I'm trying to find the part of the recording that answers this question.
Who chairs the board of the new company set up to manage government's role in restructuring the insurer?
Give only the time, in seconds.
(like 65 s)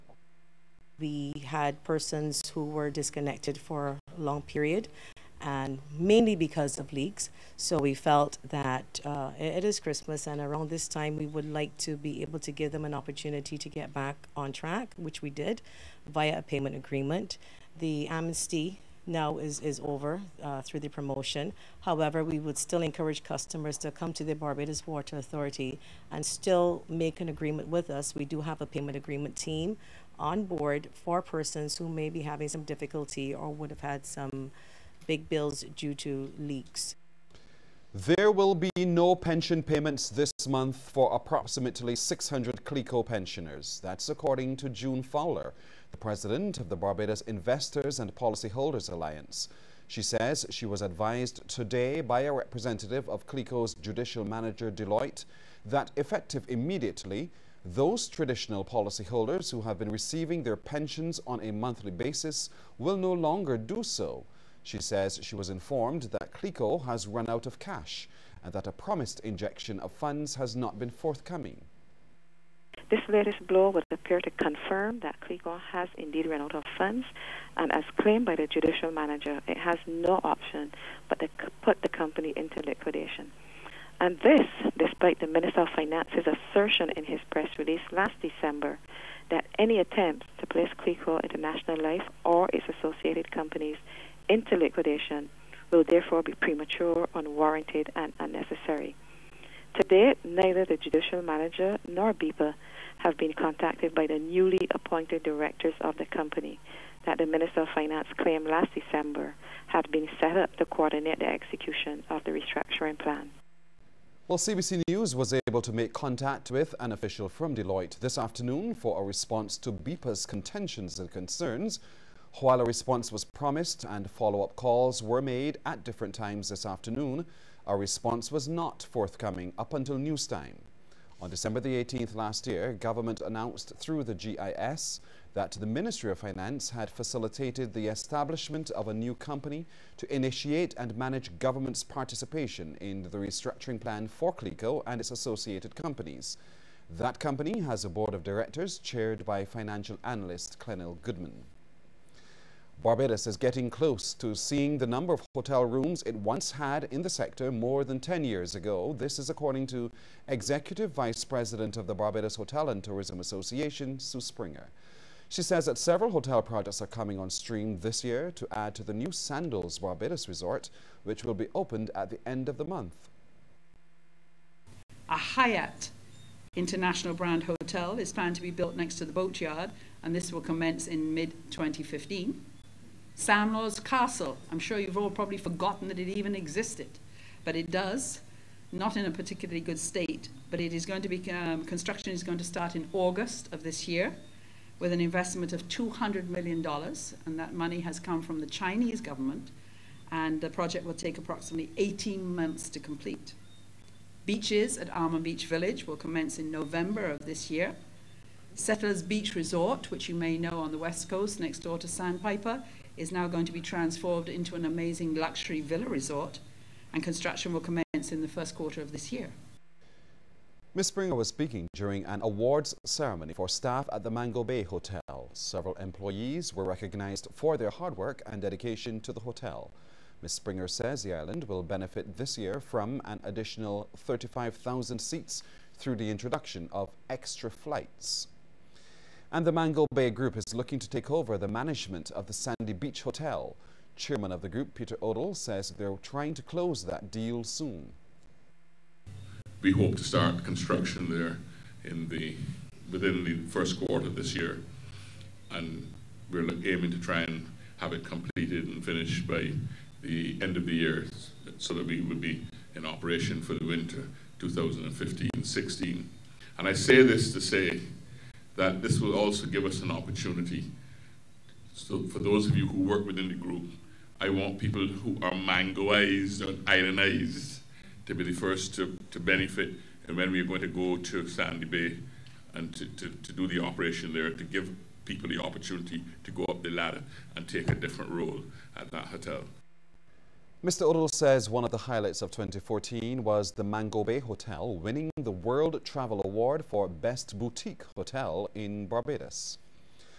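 150 s.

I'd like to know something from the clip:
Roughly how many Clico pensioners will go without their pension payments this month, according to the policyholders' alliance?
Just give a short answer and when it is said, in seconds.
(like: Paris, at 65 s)
600, at 41 s.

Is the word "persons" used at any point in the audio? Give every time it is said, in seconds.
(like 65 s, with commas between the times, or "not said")
1 s, 31 s.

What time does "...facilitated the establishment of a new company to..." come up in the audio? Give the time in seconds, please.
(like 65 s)
136 s.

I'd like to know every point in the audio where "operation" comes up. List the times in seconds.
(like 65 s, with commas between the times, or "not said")
262 s, 283 s.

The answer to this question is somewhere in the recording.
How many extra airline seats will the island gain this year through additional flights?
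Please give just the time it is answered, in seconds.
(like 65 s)
233 s.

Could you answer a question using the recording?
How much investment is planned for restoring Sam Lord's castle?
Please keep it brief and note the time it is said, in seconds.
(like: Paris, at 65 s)
$200 million, at 195 s.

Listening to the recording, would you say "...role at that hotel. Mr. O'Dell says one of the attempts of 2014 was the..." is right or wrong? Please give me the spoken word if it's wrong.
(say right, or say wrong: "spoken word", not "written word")
wrong: "highlights", not "attempts".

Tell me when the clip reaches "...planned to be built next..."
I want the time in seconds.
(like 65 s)
178 s.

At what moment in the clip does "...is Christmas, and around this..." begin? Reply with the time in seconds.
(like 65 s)
9 s.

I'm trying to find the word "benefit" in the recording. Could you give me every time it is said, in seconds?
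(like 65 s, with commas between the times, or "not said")
231 s, 279 s.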